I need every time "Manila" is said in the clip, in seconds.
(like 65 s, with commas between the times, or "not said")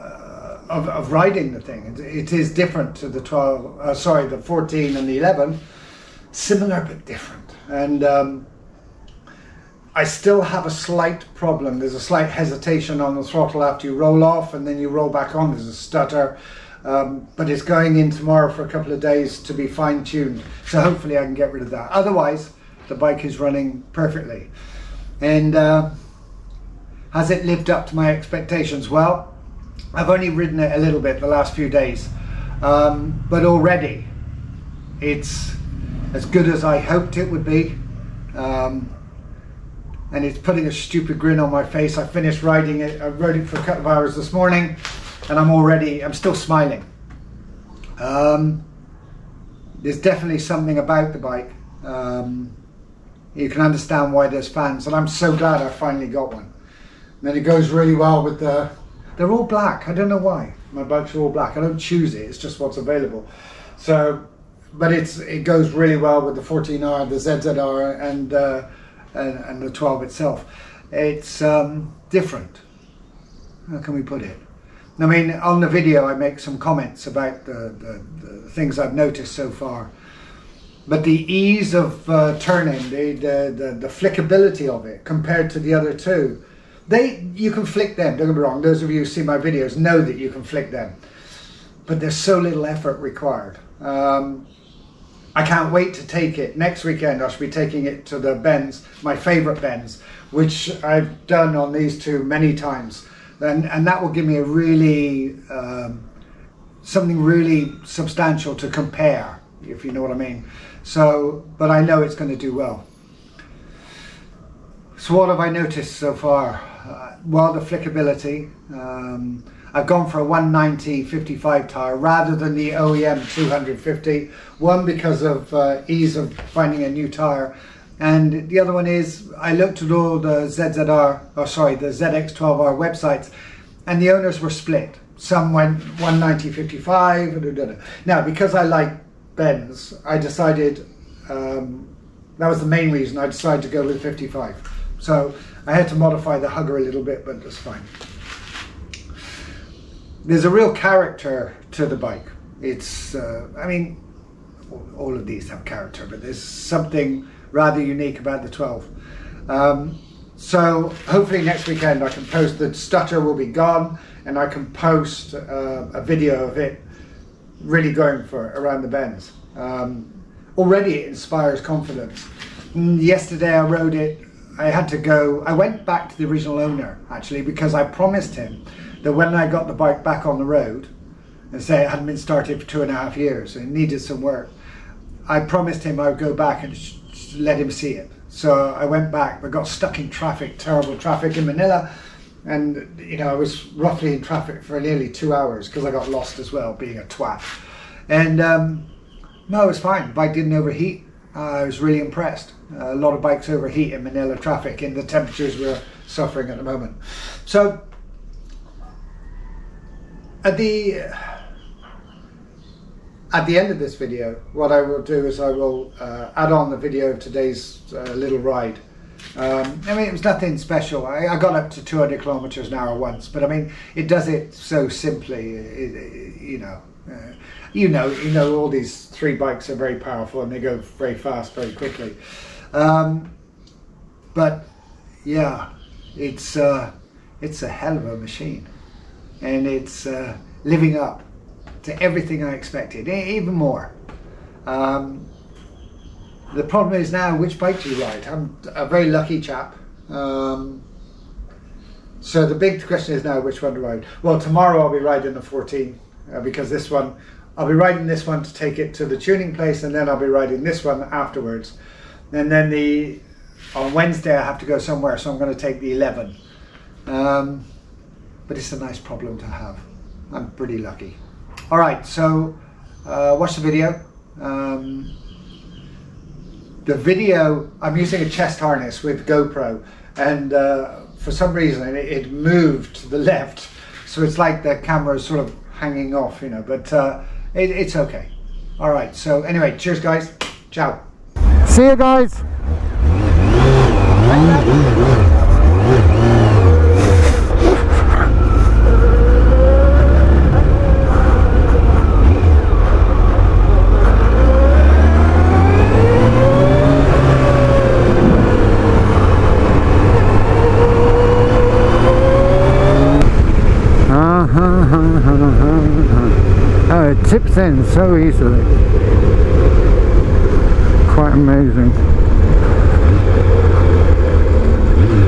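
191 s, 204 s.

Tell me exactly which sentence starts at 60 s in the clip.
My bikes are all black, I don't choose it, it's just what's available.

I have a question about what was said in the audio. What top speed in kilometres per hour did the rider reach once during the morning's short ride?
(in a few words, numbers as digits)
200.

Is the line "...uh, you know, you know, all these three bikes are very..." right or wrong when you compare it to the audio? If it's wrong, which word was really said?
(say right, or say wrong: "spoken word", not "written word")
right.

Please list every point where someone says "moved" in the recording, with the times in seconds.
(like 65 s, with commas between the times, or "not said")
282 s.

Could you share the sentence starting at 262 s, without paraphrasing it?
And then the on Wednesday I have to go somewhere, so I'm going to take the 11.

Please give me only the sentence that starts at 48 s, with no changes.
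Um, there's definitely something about the bike.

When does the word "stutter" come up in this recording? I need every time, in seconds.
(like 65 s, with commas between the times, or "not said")
15 s, 162 s.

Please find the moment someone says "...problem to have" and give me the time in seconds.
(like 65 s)
268 s.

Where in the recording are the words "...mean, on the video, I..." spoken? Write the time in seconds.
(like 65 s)
75 s.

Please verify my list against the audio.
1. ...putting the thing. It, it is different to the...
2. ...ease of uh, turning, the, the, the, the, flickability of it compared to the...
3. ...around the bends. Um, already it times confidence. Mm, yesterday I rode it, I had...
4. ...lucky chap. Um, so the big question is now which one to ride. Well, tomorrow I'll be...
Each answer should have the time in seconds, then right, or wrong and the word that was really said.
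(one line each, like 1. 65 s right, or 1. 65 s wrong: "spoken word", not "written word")
1. 1 s wrong: "riding", not "putting"
2. 81 s right
3. 168 s wrong: "inspires", not "times"
4. 249 s right.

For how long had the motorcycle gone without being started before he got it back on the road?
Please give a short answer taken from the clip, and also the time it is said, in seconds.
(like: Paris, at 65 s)
two and a half years, at 182 s.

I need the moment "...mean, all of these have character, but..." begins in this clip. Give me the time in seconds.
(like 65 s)
153 s.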